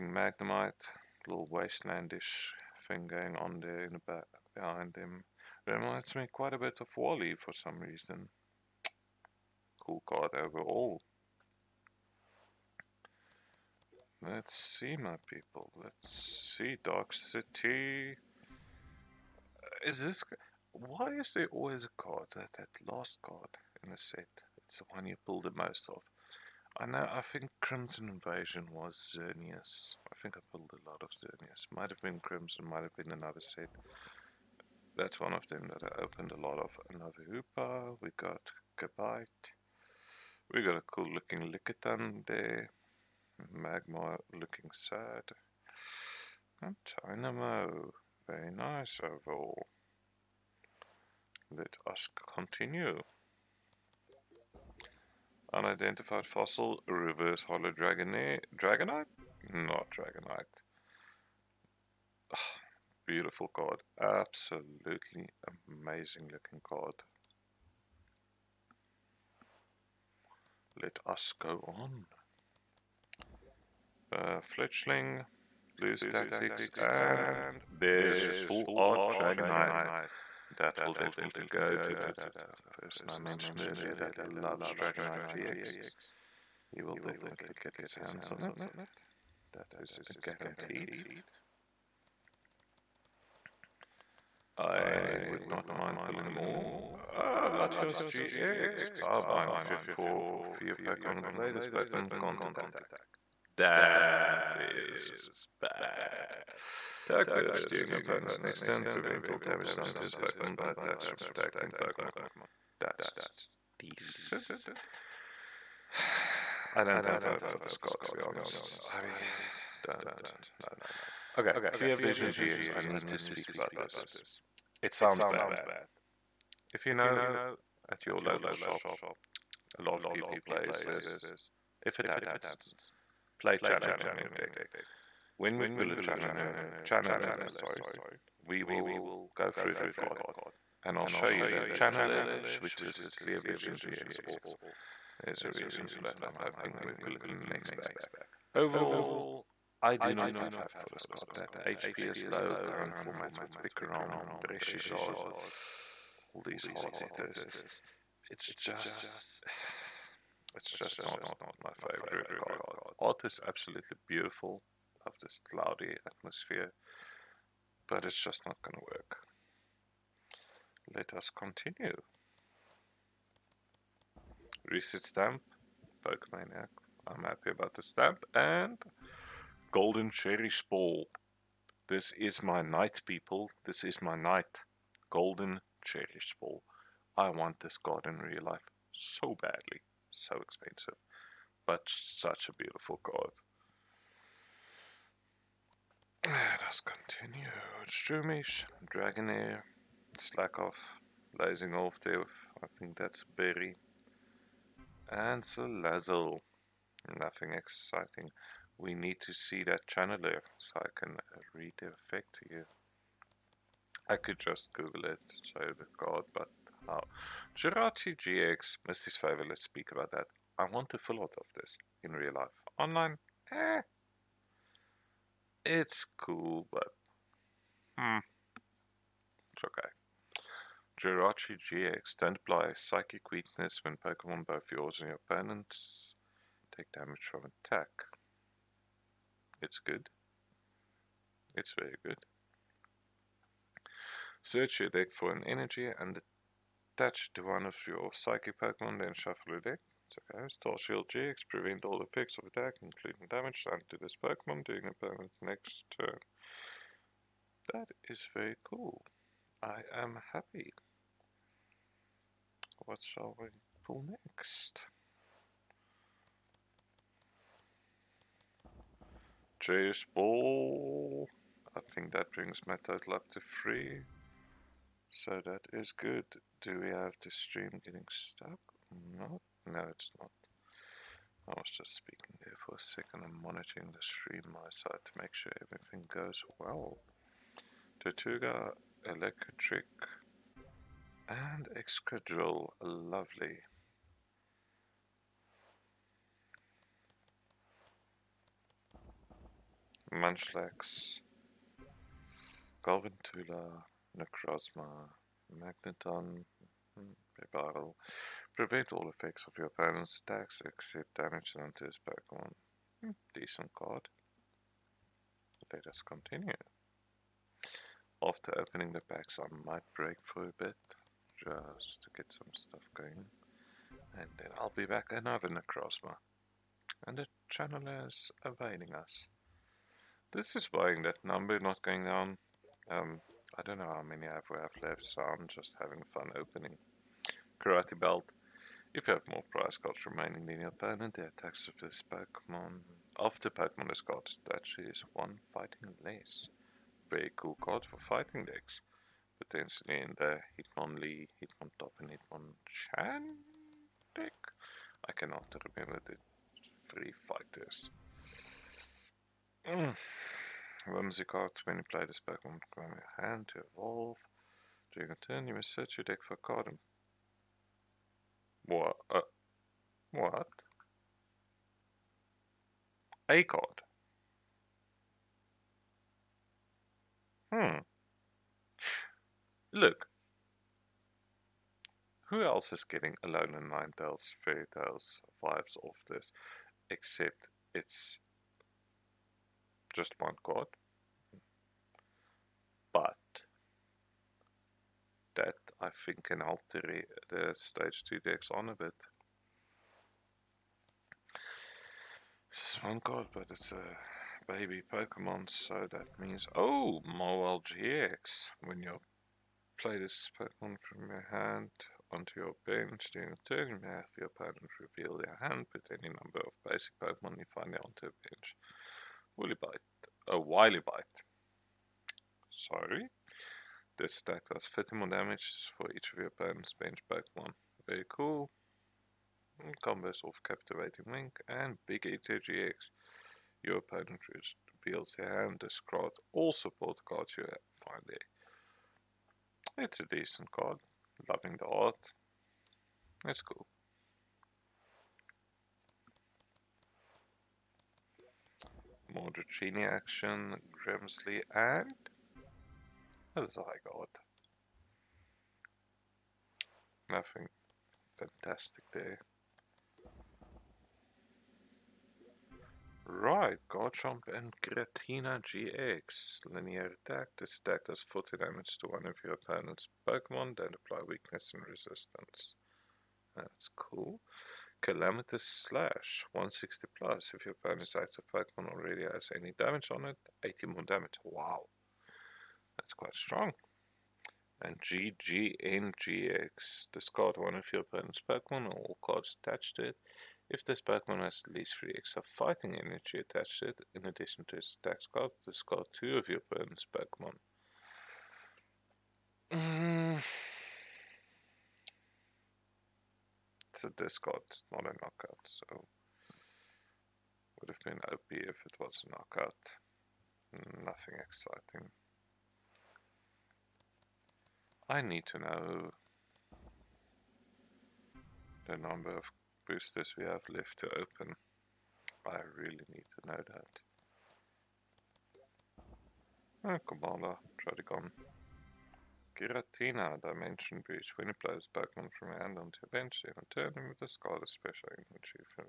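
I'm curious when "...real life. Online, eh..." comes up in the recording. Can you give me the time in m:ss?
3:42.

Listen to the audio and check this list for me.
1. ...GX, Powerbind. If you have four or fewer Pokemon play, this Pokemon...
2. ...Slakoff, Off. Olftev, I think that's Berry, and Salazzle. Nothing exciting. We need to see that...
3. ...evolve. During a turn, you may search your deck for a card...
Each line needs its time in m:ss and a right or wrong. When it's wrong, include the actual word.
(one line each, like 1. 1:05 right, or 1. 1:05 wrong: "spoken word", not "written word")
1. 1:38 right
2. 3:20 right
3. 6:03 right.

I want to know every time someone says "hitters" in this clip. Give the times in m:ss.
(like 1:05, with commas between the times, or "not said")
2:36.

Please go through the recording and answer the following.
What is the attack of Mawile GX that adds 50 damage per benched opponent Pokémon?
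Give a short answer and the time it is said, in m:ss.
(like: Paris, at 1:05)
Wily Bite, at 7:00.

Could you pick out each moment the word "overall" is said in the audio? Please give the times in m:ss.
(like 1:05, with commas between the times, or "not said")
0:10, 0:49, 2:28.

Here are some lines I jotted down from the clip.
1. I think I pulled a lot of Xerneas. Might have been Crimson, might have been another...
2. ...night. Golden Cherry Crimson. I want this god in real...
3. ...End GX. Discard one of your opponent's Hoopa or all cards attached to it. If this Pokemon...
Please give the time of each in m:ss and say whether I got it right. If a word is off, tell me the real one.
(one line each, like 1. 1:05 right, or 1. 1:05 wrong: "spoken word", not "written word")
1. 0:30 right
2. 3:04 wrong: "Ball", not "Crimson"
3. 8:05 wrong: "Pokemon", not "Hoopa".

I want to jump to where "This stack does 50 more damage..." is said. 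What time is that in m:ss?
7:03.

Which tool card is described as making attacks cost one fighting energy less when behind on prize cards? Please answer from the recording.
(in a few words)
Karate belt.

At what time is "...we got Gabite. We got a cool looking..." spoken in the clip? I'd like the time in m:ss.
0:38.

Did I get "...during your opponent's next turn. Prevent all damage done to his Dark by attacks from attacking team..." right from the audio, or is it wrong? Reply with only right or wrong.
wrong.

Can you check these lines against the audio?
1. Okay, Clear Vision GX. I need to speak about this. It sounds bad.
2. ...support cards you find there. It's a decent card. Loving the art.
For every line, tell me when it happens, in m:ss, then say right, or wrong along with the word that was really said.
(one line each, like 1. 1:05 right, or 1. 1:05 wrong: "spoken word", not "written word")
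1. 2:01 right
2. 7:16 right.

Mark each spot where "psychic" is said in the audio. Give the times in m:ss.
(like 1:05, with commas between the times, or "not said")
3:52, 4:08.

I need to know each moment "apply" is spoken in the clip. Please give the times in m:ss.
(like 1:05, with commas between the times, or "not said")
3:52, 7:50.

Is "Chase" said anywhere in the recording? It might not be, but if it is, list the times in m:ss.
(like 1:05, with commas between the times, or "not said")
4:29.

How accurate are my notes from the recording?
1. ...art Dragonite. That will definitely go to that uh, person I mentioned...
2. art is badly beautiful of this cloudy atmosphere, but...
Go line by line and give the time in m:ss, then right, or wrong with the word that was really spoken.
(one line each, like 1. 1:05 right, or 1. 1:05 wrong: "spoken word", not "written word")
1. 1:18 right
2. 2:43 wrong: "absolutely", not "badly".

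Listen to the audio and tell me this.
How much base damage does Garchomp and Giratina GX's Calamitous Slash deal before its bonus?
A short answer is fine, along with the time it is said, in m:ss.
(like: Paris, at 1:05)
160, at 7:56.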